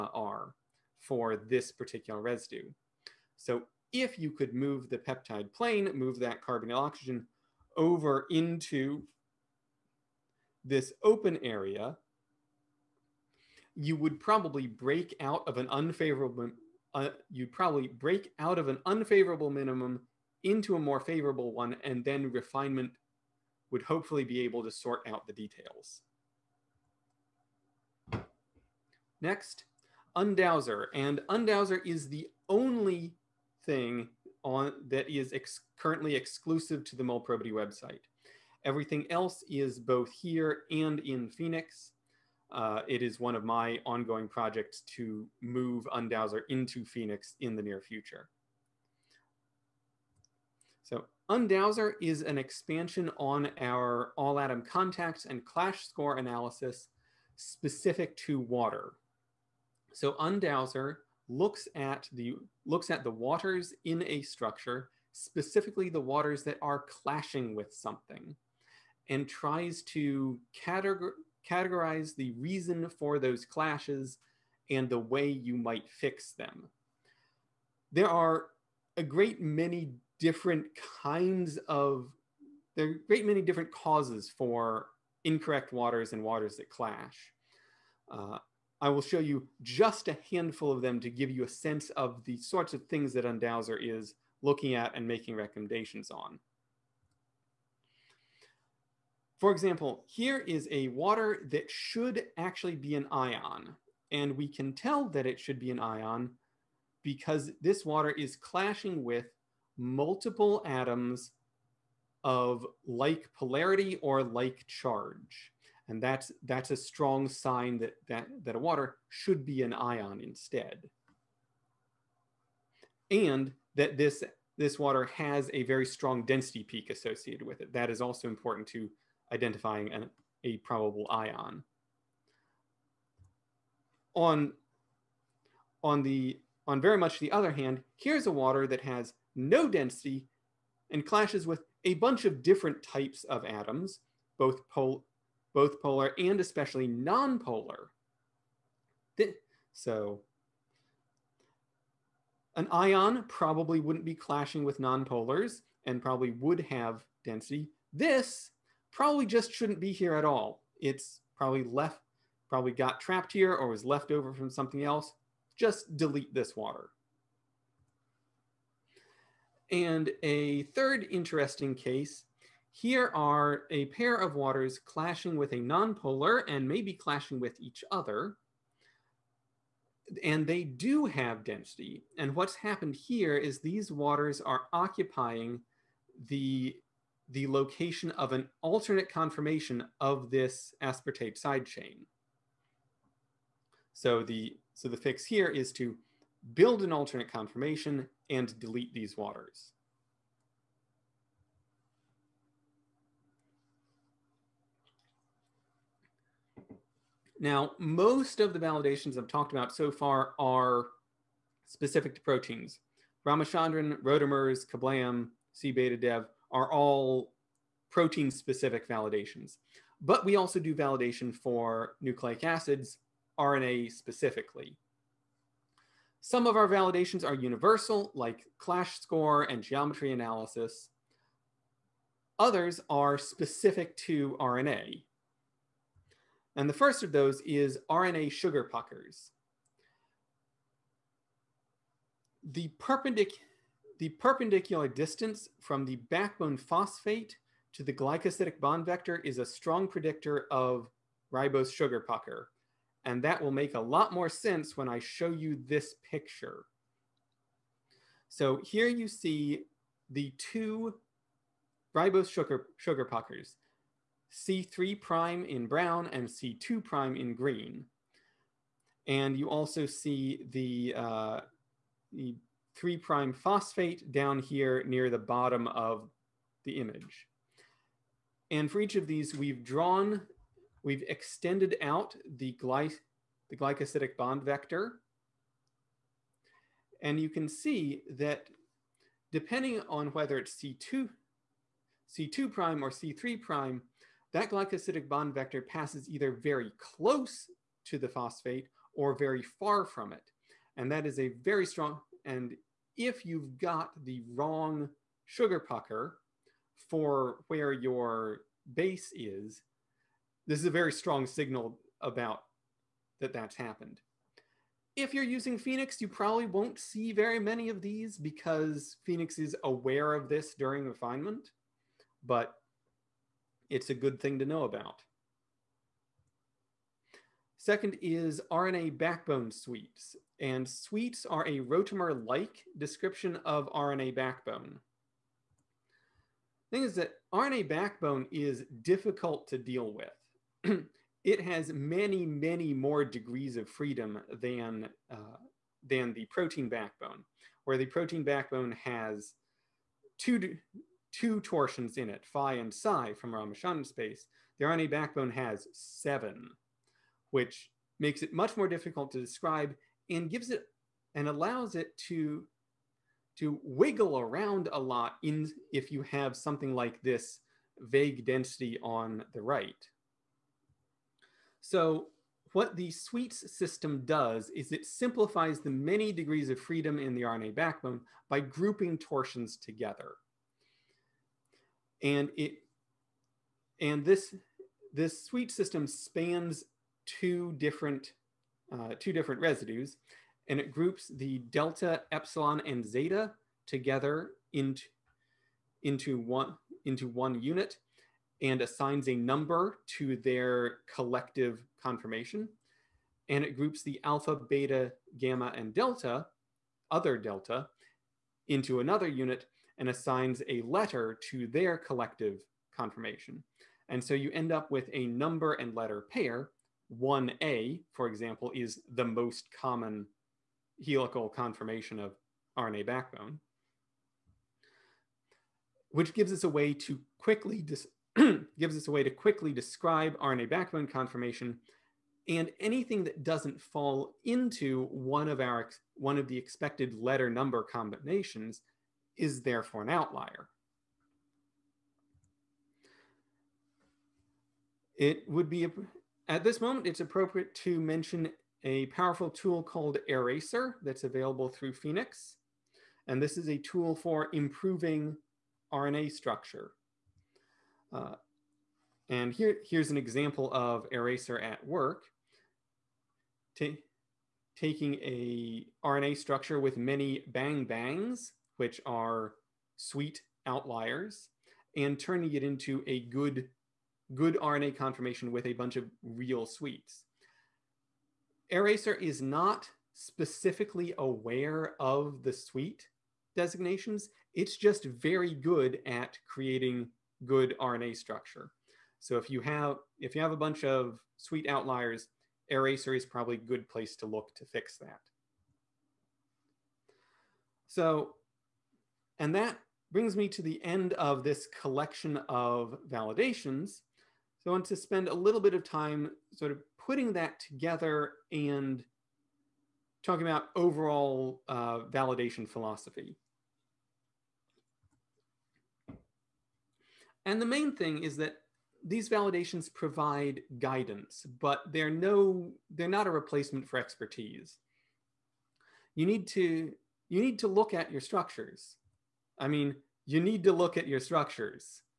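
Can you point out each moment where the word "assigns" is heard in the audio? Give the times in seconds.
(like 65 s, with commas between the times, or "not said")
398 s, 409 s.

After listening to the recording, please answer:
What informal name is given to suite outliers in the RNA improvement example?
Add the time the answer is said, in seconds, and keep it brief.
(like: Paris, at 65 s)
bang bangs, at 467 s.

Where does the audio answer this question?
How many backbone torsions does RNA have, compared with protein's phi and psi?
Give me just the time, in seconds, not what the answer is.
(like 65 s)
355 s.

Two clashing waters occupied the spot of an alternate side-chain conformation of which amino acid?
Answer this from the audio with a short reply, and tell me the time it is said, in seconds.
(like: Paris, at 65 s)
aspartate, at 190 s.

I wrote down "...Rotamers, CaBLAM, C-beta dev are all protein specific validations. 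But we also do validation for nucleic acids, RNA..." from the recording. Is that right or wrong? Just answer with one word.
right.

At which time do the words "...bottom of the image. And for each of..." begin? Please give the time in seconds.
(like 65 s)
275 s.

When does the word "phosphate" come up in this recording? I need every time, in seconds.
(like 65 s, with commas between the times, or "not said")
246 s, 273 s, 298 s.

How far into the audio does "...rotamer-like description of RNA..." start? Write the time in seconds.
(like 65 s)
331 s.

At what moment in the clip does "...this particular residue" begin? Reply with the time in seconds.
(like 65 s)
1 s.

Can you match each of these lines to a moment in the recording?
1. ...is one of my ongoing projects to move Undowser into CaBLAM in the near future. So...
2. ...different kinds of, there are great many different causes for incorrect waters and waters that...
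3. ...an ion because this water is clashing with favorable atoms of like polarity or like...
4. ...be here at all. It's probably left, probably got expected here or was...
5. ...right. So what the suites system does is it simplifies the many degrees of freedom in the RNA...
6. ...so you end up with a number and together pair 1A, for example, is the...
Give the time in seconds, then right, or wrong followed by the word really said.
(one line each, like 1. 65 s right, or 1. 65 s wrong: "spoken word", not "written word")
1. 43 s wrong: "Phenix", not "CaBLAM"
2. 80 s right
3. 105 s wrong: "multiple", not "favorable"
4. 159 s wrong: "trapped", not "expected"
5. 369 s right
6. 414 s wrong: "letter", not "together".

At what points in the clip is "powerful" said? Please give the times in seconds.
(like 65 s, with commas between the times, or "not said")
448 s.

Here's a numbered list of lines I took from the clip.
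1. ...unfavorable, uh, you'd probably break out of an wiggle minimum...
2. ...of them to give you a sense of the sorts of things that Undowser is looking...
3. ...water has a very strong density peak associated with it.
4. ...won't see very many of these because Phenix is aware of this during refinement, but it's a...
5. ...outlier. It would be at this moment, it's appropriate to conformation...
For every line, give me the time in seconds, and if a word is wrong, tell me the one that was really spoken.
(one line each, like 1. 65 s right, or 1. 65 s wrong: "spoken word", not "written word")
1. 15 s wrong: "unfavorable", not "wiggle"
2. 90 s right
3. 124 s right
4. 316 s right
5. 439 s wrong: "mention", not "conformation".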